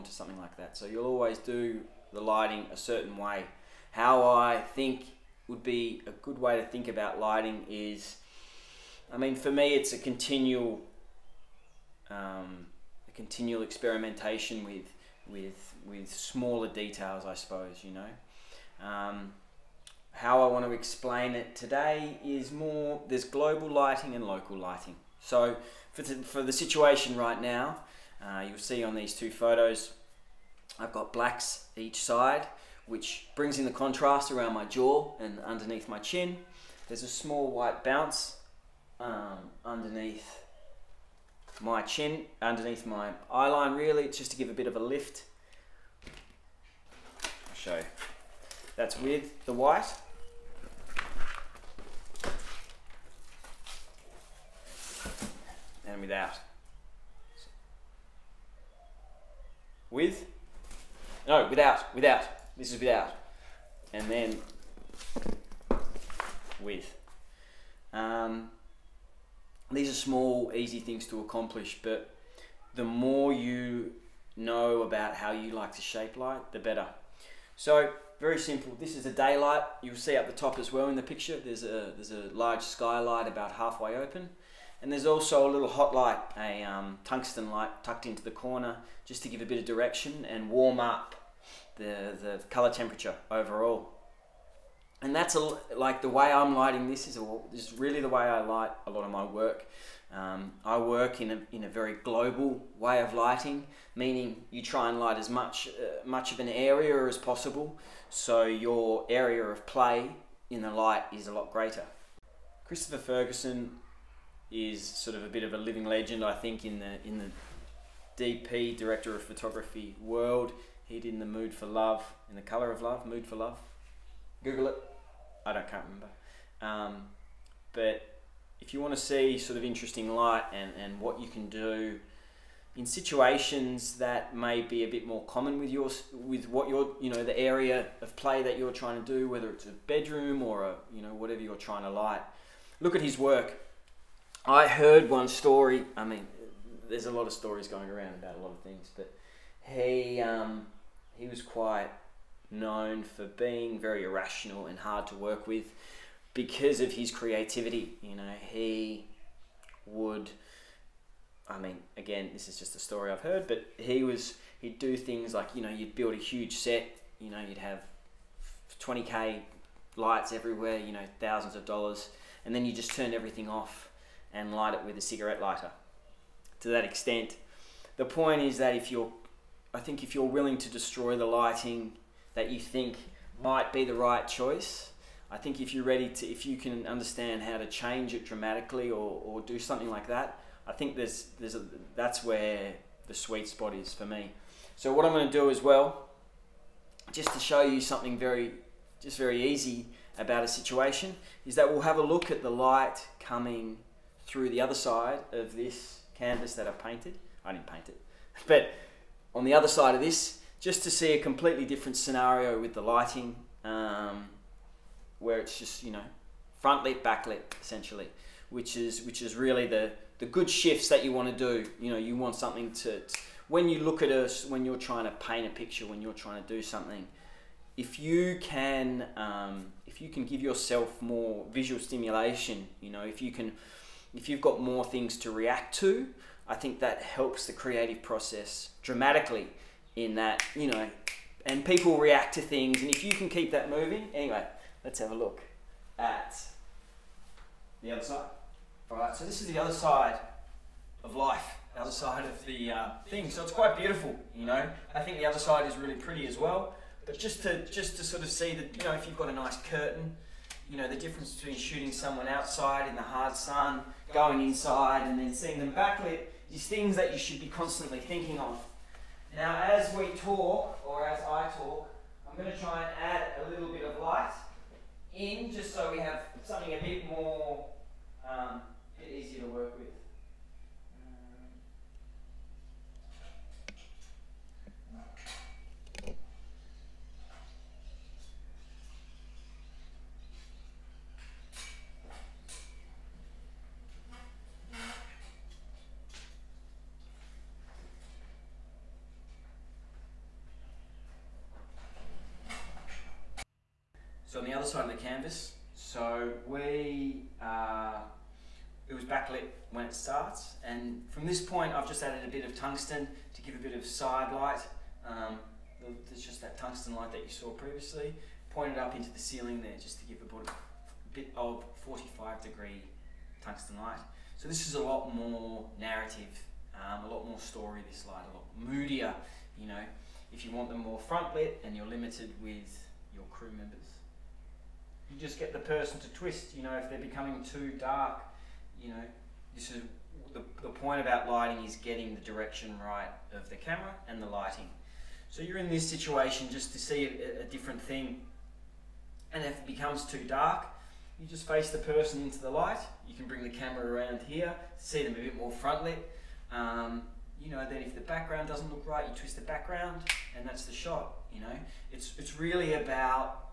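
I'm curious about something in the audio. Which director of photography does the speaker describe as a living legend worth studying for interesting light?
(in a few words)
Christopher Ferguson.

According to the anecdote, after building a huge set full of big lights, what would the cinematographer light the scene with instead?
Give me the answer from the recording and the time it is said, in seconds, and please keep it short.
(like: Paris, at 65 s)
A cigarette lighter, at 175 s.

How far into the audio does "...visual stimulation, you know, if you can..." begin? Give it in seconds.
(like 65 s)
231 s.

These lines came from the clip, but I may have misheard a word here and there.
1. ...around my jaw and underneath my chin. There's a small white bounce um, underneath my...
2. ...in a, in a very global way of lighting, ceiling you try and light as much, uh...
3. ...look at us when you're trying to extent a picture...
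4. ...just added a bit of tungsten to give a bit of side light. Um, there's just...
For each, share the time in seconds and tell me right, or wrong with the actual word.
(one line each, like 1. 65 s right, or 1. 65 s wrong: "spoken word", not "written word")
1. 34 s right
2. 101 s wrong: "meaning", not "ceiling"
3. 223 s wrong: "paint", not "extent"
4. 311 s right.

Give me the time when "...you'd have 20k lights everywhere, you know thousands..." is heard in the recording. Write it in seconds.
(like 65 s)
167 s.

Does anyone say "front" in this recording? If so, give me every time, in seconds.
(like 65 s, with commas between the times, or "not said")
216 s, 330 s, 355 s.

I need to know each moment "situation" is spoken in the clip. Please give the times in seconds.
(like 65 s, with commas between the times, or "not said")
26 s, 132 s, 200 s, 345 s.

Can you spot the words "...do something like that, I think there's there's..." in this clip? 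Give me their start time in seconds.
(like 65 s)
189 s.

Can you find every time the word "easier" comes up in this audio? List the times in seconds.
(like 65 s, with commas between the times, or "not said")
279 s.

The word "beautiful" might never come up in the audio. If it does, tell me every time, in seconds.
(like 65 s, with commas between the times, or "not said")
253 s.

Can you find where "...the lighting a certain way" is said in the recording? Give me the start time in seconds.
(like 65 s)
2 s.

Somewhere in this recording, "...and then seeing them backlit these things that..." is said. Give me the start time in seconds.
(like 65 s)
265 s.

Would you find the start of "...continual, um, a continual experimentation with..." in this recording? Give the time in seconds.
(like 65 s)
9 s.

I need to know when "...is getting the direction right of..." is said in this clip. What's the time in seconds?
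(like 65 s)
341 s.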